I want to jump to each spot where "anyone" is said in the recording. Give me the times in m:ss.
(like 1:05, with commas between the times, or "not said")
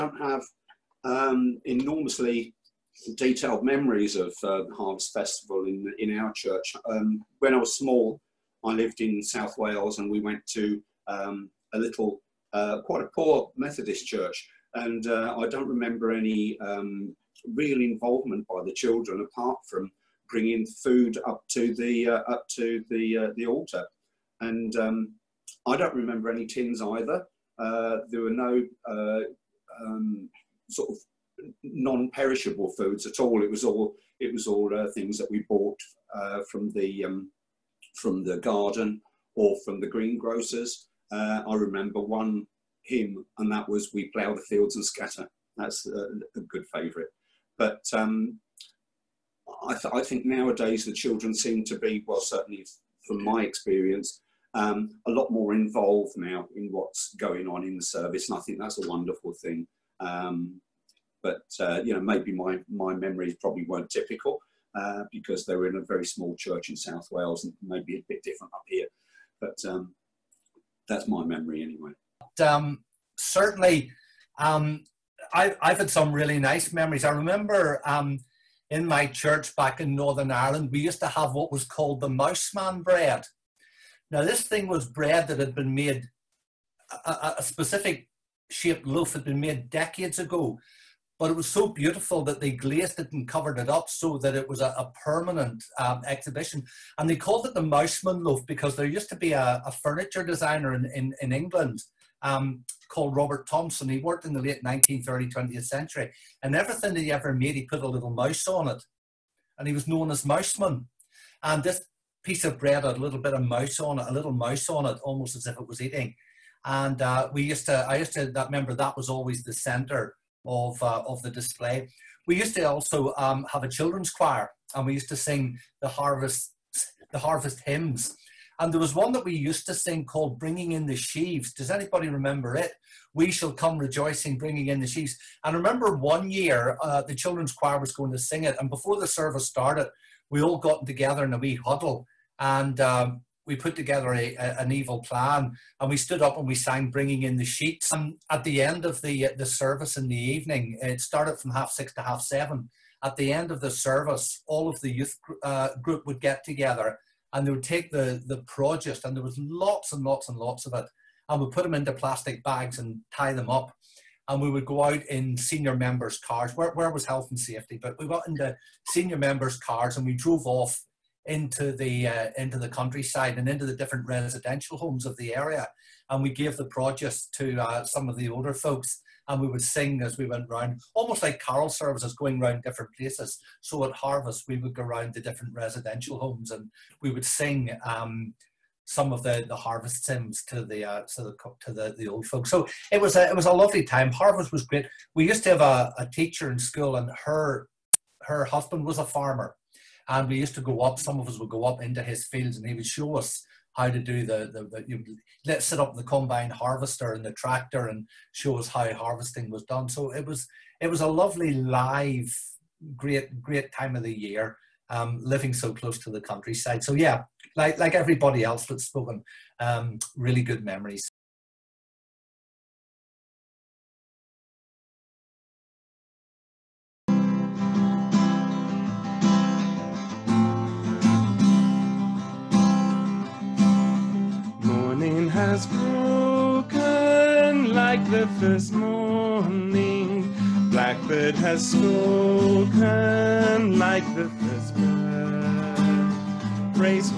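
not said.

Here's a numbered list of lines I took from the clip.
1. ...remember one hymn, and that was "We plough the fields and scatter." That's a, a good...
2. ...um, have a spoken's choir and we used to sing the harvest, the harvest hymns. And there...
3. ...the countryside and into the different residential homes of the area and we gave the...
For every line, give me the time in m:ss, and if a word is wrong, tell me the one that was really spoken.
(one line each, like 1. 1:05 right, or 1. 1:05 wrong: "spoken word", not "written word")
1. 0:41 right
2. 2:03 wrong: "children", not "spoken"
3. 2:52 right.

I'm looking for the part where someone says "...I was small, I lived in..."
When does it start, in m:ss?
0:07.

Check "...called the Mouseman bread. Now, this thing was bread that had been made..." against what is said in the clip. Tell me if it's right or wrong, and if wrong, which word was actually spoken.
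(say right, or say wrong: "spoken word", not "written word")
right.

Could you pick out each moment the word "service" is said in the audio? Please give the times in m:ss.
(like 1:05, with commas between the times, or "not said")
0:57, 2:19, 2:29, 2:33, 3:01.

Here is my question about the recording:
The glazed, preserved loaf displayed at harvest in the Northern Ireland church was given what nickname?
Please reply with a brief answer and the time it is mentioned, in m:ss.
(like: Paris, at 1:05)
Mouseman loaf, at 1:37.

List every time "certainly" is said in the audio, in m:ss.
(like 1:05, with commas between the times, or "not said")
0:52, 1:13.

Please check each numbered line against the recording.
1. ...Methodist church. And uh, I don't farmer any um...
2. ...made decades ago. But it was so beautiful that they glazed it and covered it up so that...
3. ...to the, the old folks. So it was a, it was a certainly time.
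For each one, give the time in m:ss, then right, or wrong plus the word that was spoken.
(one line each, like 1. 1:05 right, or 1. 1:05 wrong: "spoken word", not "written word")
1. 0:13 wrong: "remember", not "farmer"
2. 1:29 right
3. 3:11 wrong: "lovely", not "certainly".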